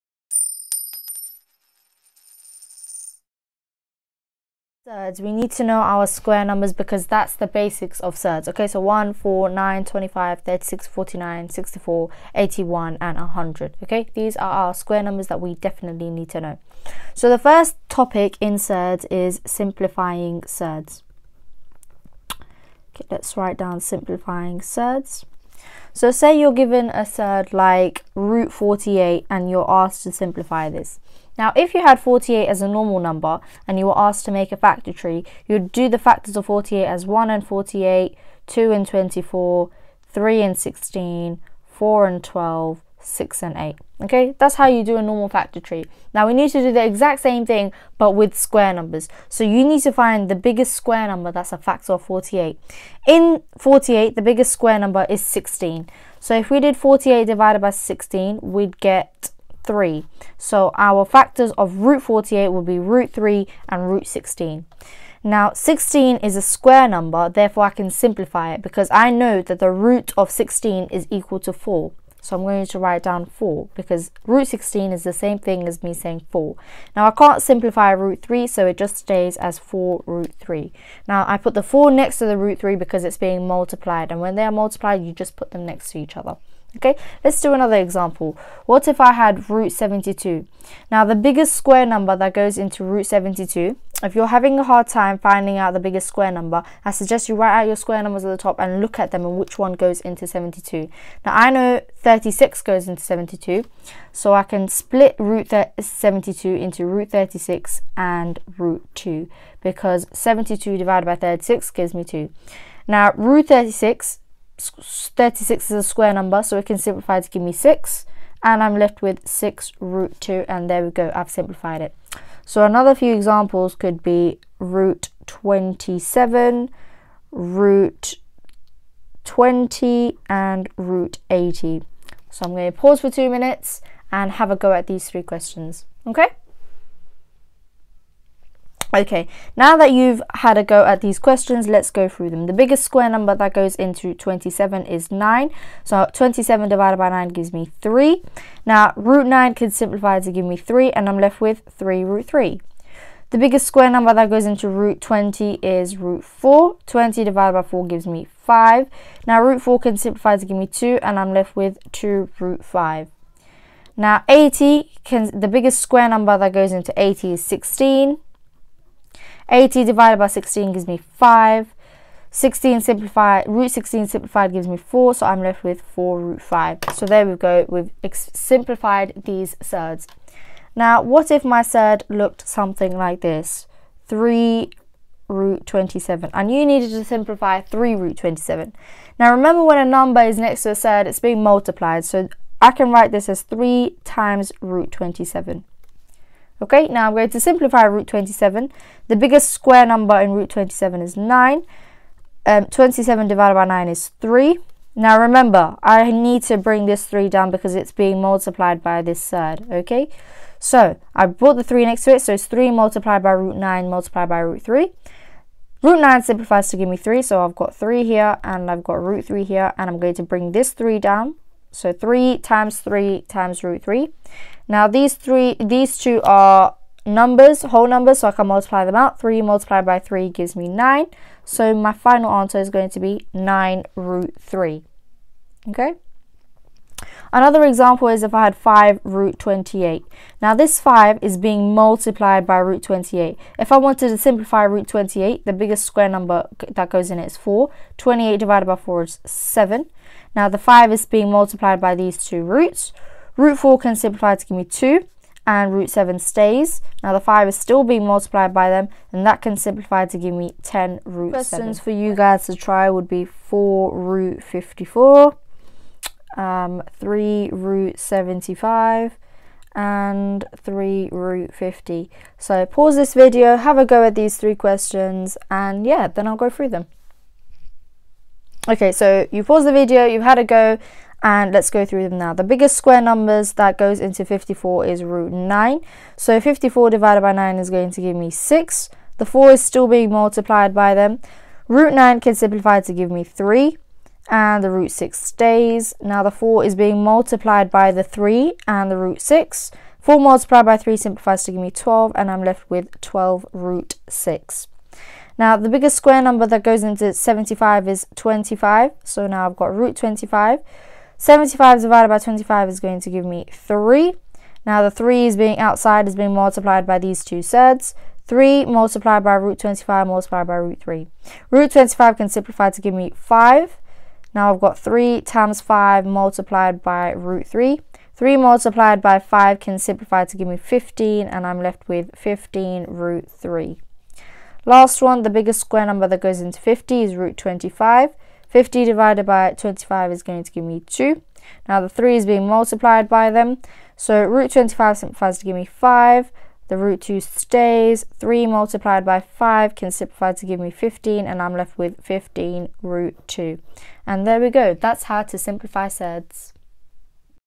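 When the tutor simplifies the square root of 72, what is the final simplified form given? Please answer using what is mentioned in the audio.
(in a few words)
6 root 2.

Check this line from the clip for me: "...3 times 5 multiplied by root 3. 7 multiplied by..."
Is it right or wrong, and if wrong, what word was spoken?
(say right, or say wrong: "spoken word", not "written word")
wrong: "3", not "7".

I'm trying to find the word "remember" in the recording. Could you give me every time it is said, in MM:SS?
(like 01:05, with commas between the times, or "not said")
03:09, 03:25.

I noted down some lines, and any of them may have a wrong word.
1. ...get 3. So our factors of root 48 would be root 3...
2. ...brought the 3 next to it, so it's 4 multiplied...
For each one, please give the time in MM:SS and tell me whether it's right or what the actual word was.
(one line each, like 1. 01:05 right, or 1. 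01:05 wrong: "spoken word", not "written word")
1. 00:58 right
2. 03:31 wrong: "3", not "4".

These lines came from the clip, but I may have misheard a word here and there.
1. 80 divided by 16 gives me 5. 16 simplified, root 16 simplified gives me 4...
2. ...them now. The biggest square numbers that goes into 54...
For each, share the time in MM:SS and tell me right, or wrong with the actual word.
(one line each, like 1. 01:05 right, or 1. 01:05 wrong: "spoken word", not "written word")
1. 02:49 right
2. 04:42 right.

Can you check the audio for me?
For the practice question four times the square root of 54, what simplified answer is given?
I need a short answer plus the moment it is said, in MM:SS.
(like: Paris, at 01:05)
12 root 6, at 05:03.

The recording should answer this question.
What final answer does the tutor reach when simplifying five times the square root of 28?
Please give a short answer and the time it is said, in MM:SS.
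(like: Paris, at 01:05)
10 root 7, at 04:20.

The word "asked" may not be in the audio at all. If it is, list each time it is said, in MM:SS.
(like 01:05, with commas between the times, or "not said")
00:29, 00:33.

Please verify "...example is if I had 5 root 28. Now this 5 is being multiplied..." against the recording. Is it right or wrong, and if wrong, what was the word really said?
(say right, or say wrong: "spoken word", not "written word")
right.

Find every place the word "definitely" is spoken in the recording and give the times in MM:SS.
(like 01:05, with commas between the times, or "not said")
00:15.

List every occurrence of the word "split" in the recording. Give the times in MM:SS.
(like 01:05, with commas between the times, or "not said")
01:44.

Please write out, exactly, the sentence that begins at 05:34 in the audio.
Last one, the biggest square number that goes into 50 is root 25.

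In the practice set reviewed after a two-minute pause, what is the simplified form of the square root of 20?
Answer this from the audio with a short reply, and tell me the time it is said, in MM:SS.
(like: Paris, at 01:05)
2 root 5, at 02:41.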